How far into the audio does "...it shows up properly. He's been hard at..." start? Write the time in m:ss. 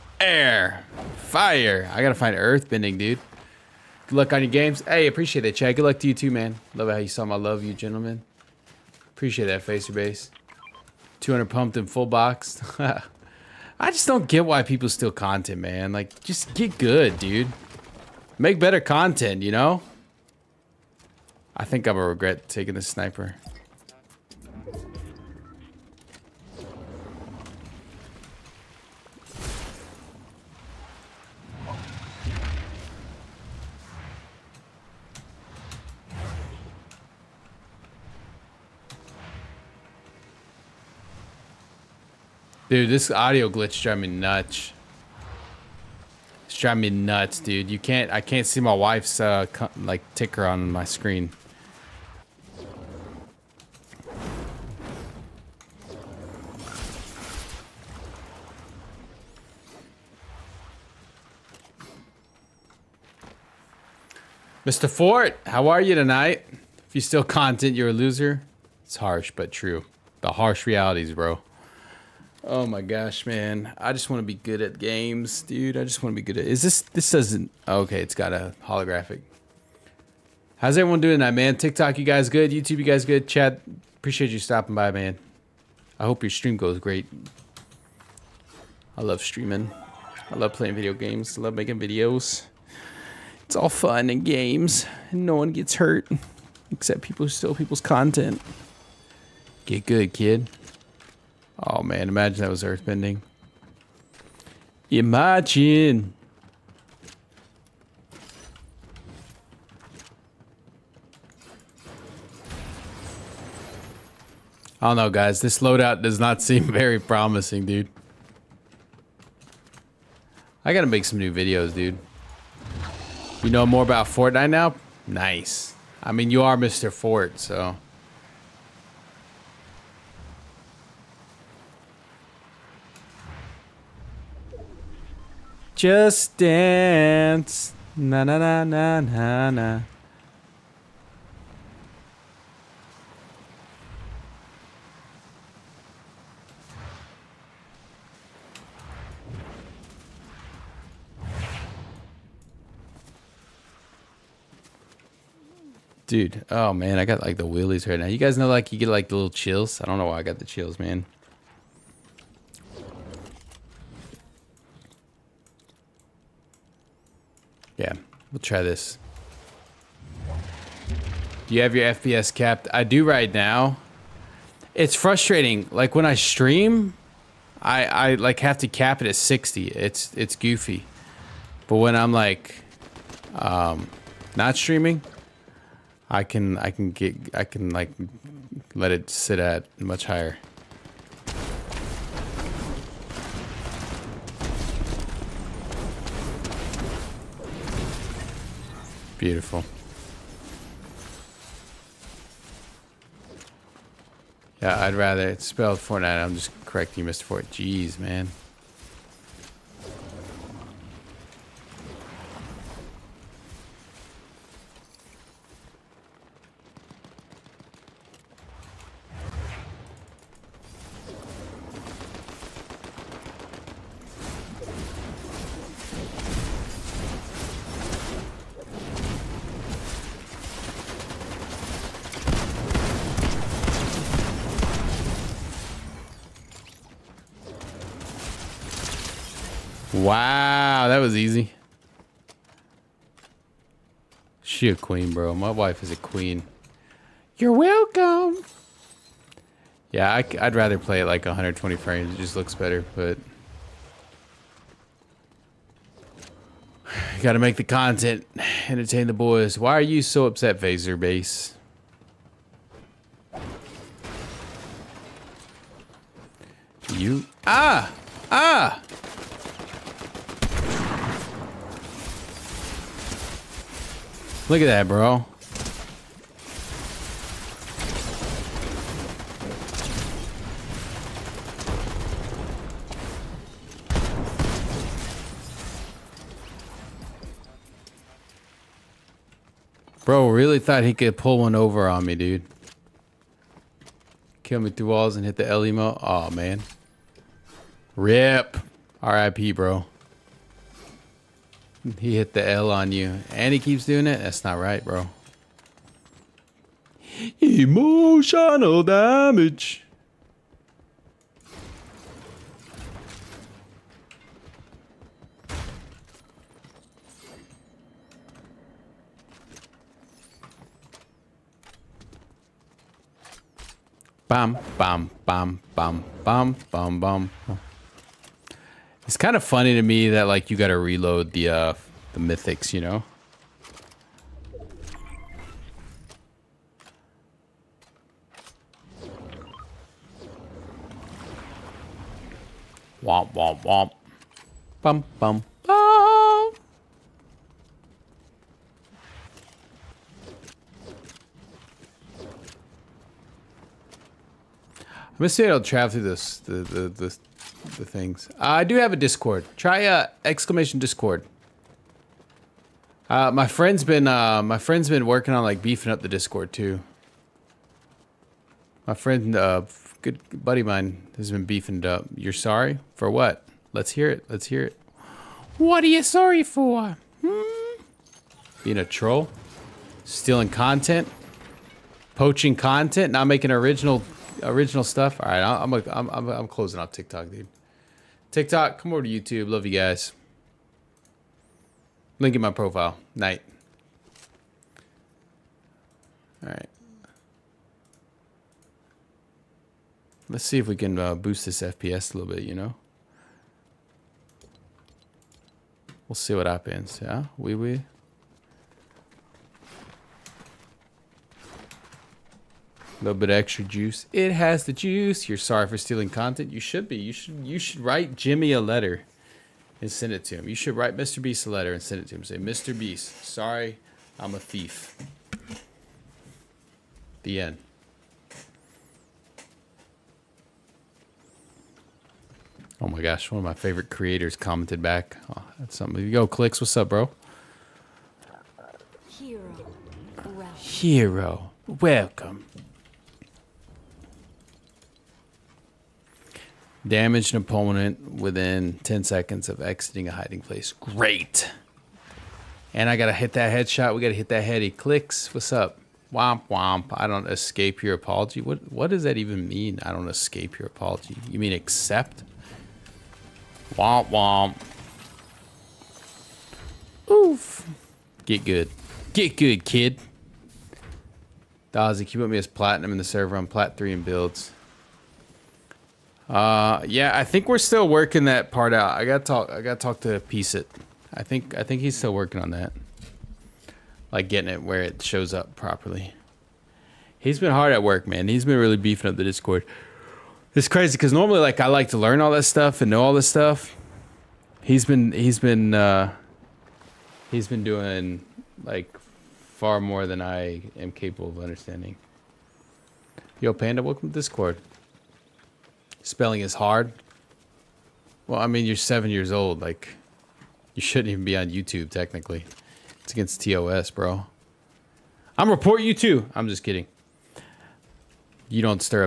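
8:04.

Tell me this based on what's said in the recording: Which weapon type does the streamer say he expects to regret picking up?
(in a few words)
Sniper.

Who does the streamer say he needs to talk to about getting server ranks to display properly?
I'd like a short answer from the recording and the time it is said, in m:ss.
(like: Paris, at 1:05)
Piece It, at 8:00.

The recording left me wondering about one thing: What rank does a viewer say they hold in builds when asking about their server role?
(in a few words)
Plat 3.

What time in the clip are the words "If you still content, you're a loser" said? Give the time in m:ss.
1:06.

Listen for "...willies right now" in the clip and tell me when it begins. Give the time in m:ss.
2:37.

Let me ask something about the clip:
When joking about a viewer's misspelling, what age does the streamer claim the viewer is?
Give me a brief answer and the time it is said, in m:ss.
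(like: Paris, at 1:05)
7, at 8:28.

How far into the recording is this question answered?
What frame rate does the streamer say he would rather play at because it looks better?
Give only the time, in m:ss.
4:11.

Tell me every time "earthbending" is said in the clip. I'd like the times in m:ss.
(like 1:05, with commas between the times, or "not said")
0:02, 1:42.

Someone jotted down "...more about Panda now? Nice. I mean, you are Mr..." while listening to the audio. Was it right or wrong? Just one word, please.
wrong.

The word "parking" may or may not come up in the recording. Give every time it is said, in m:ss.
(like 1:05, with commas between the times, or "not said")
not said.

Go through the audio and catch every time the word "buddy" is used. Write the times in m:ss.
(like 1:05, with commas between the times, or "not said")
6:10.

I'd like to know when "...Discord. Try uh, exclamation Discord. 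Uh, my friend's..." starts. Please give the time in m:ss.
5:58.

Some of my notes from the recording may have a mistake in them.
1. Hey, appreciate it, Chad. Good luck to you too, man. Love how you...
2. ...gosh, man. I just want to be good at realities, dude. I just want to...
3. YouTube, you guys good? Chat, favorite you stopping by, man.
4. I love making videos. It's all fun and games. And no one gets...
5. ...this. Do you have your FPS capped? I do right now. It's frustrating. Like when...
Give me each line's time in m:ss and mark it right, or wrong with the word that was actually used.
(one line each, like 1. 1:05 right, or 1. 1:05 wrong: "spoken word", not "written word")
1. 0:04 right
2. 1:12 wrong: "games", not "realities"
3. 1:22 wrong: "appreciate", not "favorite"
4. 1:31 right
5. 2:48 right.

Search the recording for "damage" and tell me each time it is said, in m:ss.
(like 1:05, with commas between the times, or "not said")
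5:08, 7:26.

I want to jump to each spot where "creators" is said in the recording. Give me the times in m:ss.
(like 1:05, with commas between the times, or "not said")
7:13.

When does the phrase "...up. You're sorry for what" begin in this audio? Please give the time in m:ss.
6:11.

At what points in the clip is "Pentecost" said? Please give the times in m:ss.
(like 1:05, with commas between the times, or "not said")
not said.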